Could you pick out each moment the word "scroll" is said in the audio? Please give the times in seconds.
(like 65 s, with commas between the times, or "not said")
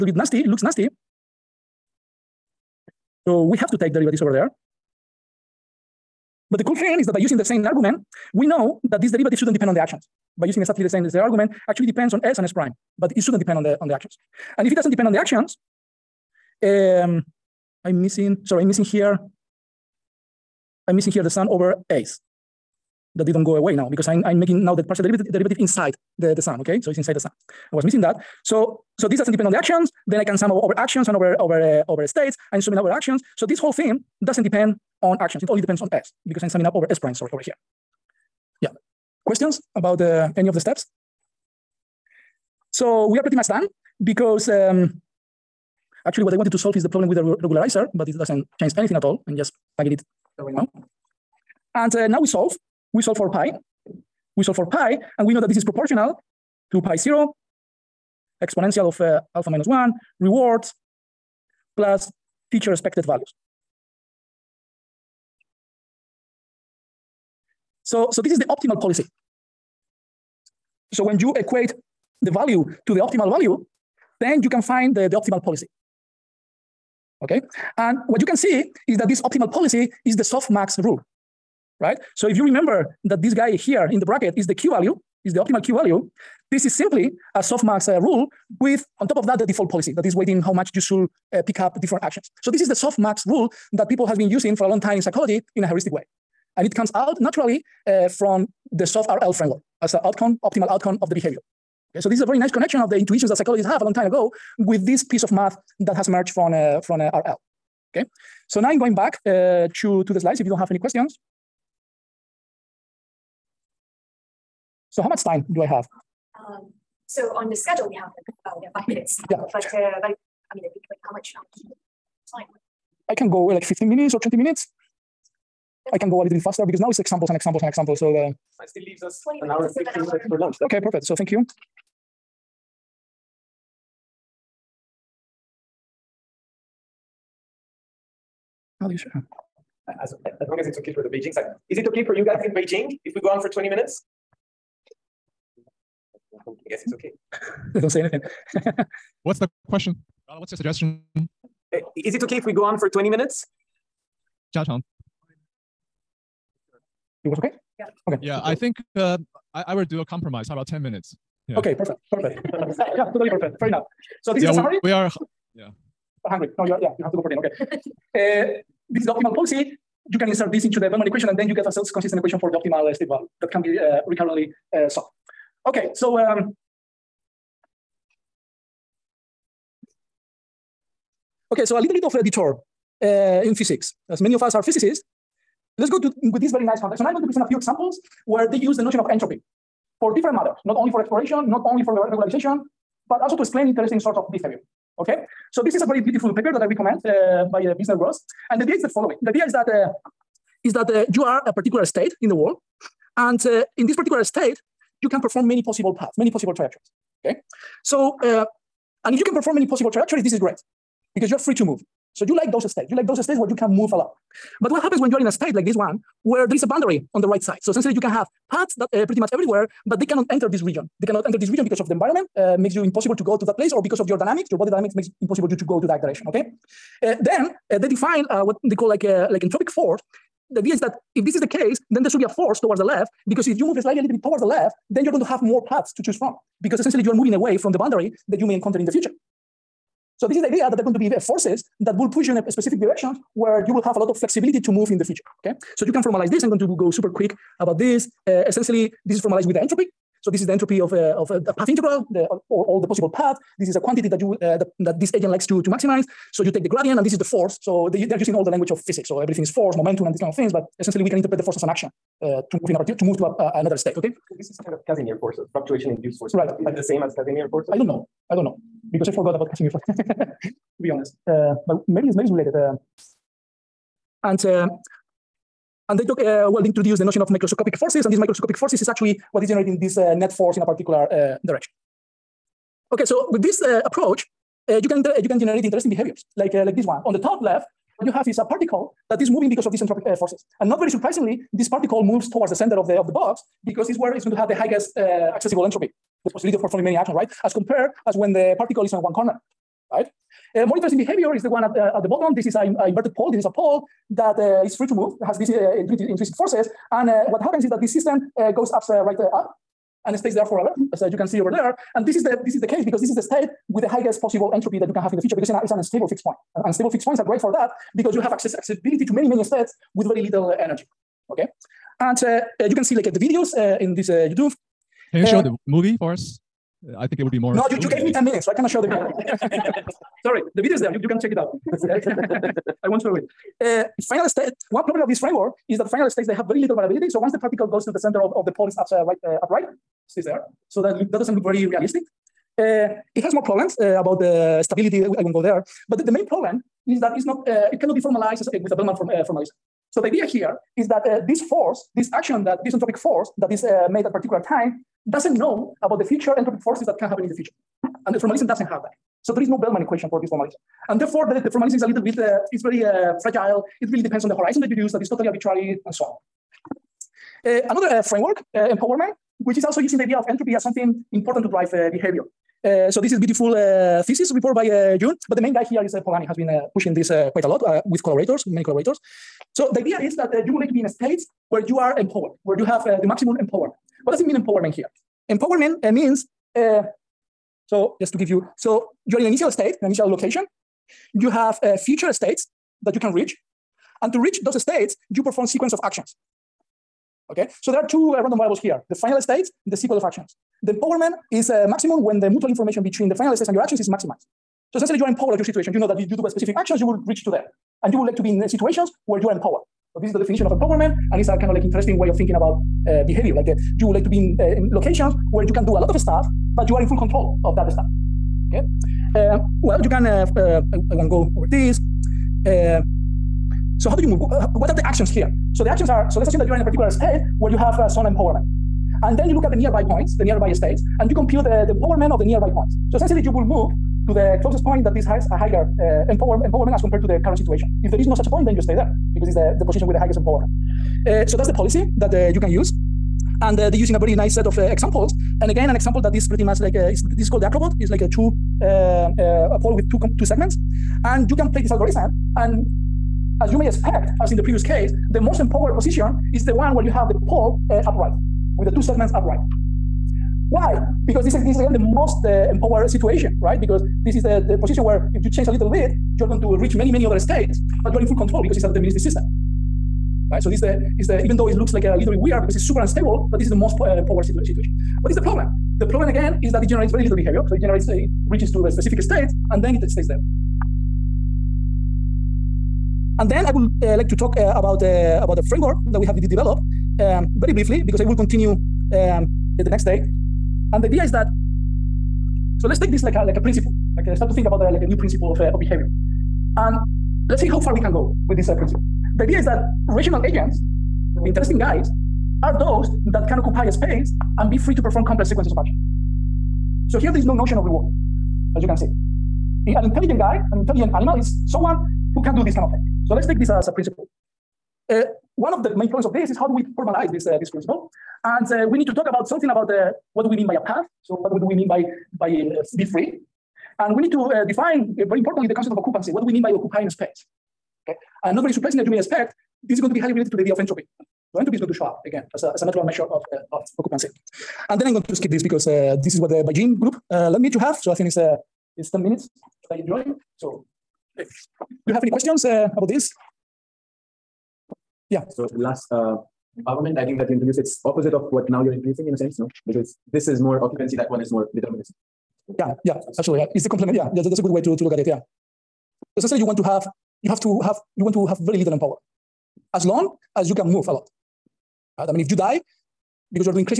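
not said.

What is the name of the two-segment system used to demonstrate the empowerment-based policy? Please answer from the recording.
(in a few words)
Acrobot.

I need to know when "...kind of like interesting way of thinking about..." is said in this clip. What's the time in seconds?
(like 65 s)
411 s.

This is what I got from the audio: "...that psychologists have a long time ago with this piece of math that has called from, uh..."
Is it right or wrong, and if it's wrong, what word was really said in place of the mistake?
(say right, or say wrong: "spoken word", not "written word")
wrong: "emerged", not "called".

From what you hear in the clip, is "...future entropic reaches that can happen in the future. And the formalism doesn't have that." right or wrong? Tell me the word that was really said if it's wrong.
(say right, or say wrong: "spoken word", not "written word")
wrong: "forces", not "reaches".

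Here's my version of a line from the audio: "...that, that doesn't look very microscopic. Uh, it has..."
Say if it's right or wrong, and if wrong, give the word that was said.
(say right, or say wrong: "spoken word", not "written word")
wrong: "realistic", not "microscopic".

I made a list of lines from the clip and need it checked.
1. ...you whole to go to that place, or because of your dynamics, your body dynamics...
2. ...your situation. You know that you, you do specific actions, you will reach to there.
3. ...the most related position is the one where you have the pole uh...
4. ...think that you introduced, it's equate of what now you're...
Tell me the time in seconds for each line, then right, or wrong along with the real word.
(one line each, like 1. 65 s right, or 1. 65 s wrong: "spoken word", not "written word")
1. 222 s wrong: "impossible", not "whole"
2. 405 s right
3. 455 s wrong: "empowered", not "related"
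4. 547 s wrong: "opposite", not "equate".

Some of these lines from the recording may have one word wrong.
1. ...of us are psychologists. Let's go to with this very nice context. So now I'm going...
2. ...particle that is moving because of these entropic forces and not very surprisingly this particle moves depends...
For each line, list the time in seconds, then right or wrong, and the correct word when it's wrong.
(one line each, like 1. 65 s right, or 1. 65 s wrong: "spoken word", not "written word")
1. 184 s wrong: "physicists", not "psychologists"
2. 288 s wrong: "towards", not "depends".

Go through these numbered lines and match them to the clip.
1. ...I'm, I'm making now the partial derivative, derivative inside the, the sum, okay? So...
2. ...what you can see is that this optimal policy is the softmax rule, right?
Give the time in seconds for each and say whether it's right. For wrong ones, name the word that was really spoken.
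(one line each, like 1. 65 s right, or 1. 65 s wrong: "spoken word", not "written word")
1. 24 s right
2. 78 s right.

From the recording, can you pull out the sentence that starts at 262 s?
Uh, to move in a particular to move to a, another state.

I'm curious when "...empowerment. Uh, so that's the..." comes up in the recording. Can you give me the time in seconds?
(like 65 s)
440 s.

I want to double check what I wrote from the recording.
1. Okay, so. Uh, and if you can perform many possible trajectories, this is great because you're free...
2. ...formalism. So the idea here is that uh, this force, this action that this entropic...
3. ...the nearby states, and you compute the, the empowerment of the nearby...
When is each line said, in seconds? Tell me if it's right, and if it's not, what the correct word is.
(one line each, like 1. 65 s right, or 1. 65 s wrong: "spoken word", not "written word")
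1. 207 s right
2. 349 s right
3. 430 s right.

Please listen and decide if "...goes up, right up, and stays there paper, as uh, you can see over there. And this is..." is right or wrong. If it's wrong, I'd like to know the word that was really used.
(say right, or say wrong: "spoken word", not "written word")
wrong: "forever", not "paper".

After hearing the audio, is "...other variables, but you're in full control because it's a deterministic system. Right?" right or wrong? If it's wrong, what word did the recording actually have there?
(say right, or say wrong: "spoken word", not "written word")
wrong: "states", not "variables".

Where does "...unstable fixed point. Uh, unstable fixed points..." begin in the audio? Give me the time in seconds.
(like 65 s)
315 s.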